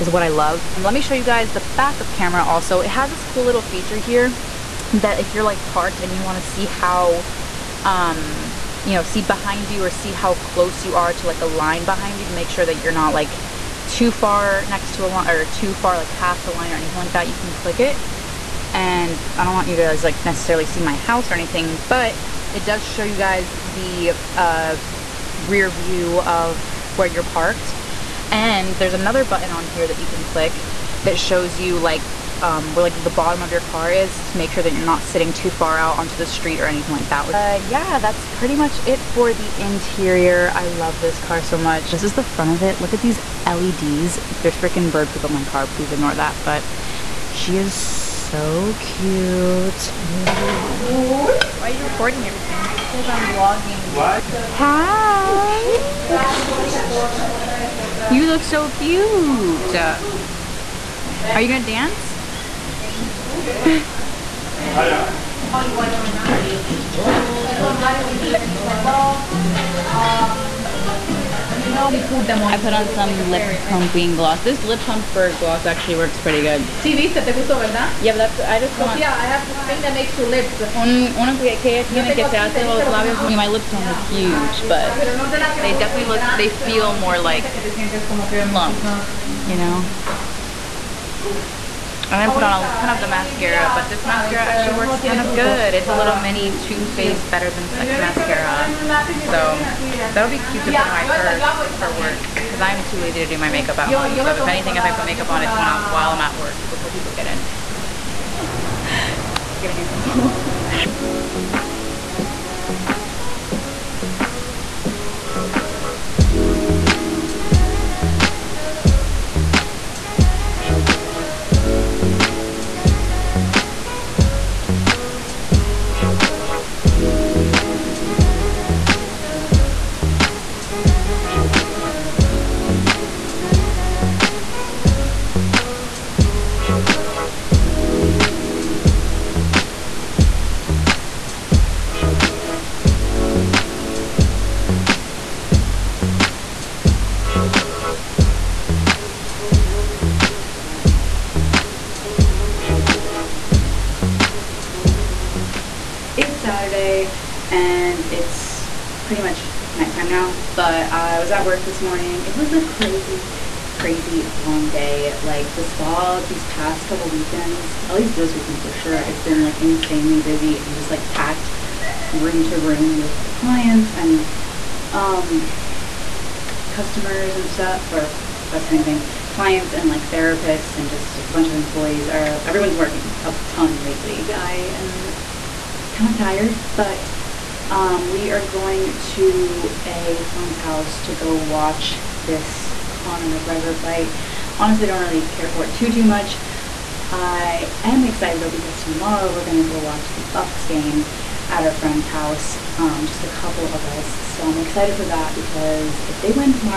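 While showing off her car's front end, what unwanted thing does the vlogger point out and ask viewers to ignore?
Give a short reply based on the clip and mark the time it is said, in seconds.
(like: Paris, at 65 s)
Bird poop, at 44 s.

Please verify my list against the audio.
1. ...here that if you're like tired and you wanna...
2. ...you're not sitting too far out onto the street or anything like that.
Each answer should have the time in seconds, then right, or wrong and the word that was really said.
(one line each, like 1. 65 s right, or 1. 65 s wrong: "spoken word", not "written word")
1. 3 s wrong: "parked", not "tired"
2. 34 s right.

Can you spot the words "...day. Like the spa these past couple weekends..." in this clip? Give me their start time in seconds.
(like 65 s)
164 s.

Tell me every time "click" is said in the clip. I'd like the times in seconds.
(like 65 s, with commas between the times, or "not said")
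17 s, 30 s.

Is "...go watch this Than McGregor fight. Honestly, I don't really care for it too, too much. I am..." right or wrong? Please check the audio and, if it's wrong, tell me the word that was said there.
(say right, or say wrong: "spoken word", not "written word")
wrong: "Conor", not "Than".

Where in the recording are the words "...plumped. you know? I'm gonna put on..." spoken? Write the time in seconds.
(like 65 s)
88 s.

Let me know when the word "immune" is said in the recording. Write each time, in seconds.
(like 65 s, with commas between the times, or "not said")
not said.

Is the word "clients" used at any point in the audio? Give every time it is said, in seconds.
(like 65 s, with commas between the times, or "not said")
173 s, 179 s.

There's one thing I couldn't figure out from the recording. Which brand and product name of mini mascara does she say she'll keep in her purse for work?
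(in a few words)
Too Faced Better Than Sex.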